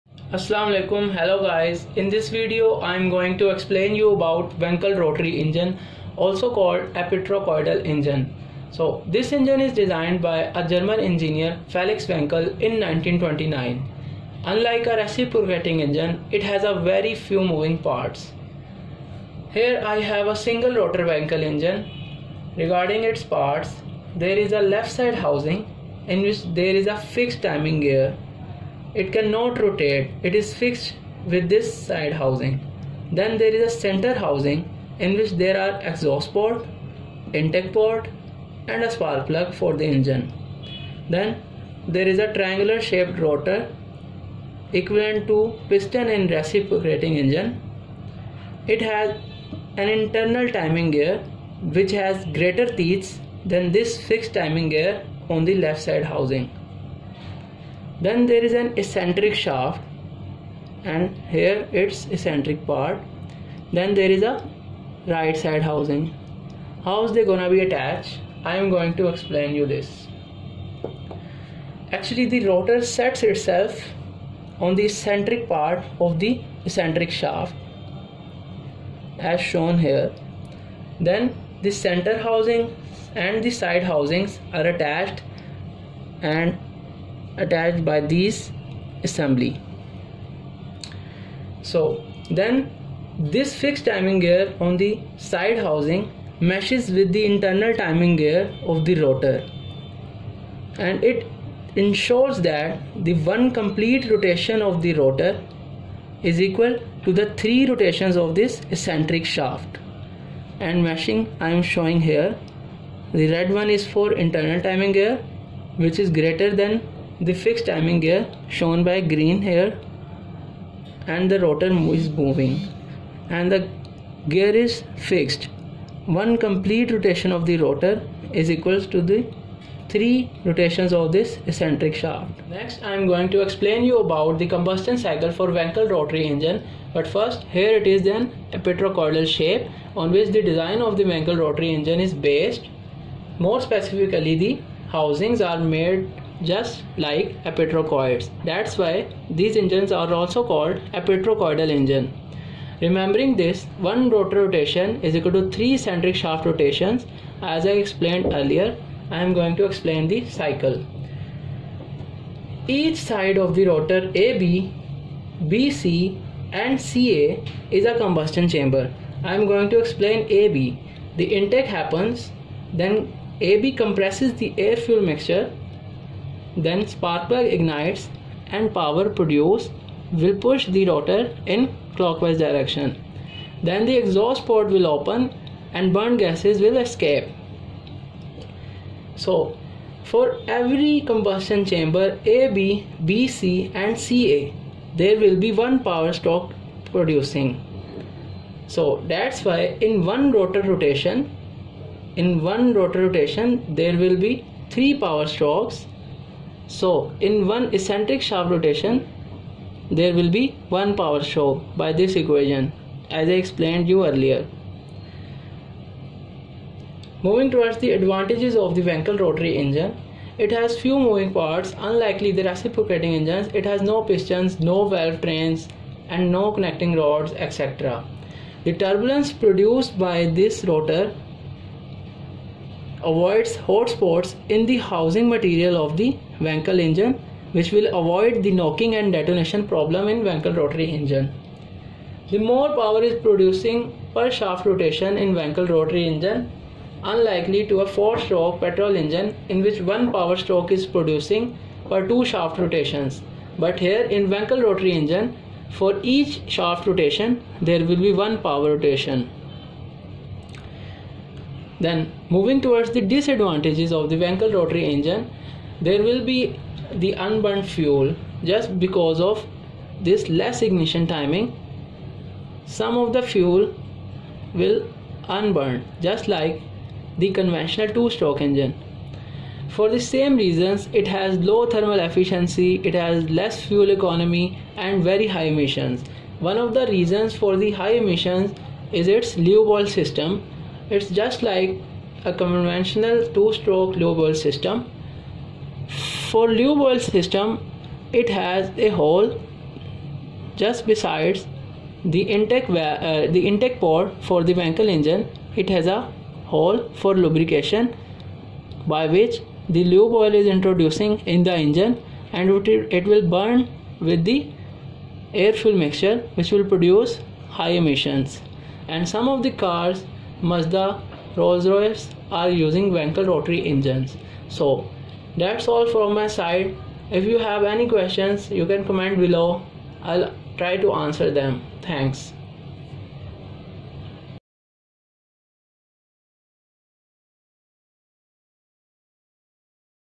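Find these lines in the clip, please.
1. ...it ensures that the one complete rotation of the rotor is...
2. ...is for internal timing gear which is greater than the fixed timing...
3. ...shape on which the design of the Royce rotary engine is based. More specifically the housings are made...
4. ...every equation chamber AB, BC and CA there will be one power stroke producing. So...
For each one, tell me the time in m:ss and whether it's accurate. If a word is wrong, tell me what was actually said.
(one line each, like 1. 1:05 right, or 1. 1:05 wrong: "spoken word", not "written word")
1. 1:41 right
2. 1:53 right
3. 2:19 wrong: "Wankel", not "Royce"
4. 3:10 wrong: "combustion", not "equation".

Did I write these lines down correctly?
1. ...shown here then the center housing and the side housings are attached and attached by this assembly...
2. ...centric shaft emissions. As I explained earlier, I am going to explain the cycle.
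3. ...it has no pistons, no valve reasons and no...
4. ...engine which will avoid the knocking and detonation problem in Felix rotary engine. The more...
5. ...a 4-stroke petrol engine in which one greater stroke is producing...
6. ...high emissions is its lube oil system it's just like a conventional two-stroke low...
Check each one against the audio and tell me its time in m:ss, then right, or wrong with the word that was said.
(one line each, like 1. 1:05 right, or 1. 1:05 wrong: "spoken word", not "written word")
1. 1:19 right
2. 2:35 wrong: "rotations", not "emissions"
3. 3:43 wrong: "trains", not "reasons"
4. 3:56 wrong: "Wankel", not "Felix"
5. 4:07 wrong: "power", not "greater"
6. 4:47 right.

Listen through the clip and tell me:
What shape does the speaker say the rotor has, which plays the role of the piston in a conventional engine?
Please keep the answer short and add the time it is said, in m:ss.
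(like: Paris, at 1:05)
Triangular, at 0:42.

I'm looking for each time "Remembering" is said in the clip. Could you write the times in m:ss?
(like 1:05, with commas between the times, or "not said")
2:32.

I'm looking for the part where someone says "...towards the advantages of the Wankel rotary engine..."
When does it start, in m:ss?
3:37.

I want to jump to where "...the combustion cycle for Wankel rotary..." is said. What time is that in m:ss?
2:14.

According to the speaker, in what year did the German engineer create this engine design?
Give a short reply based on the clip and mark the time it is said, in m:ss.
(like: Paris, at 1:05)
1929, at 0:12.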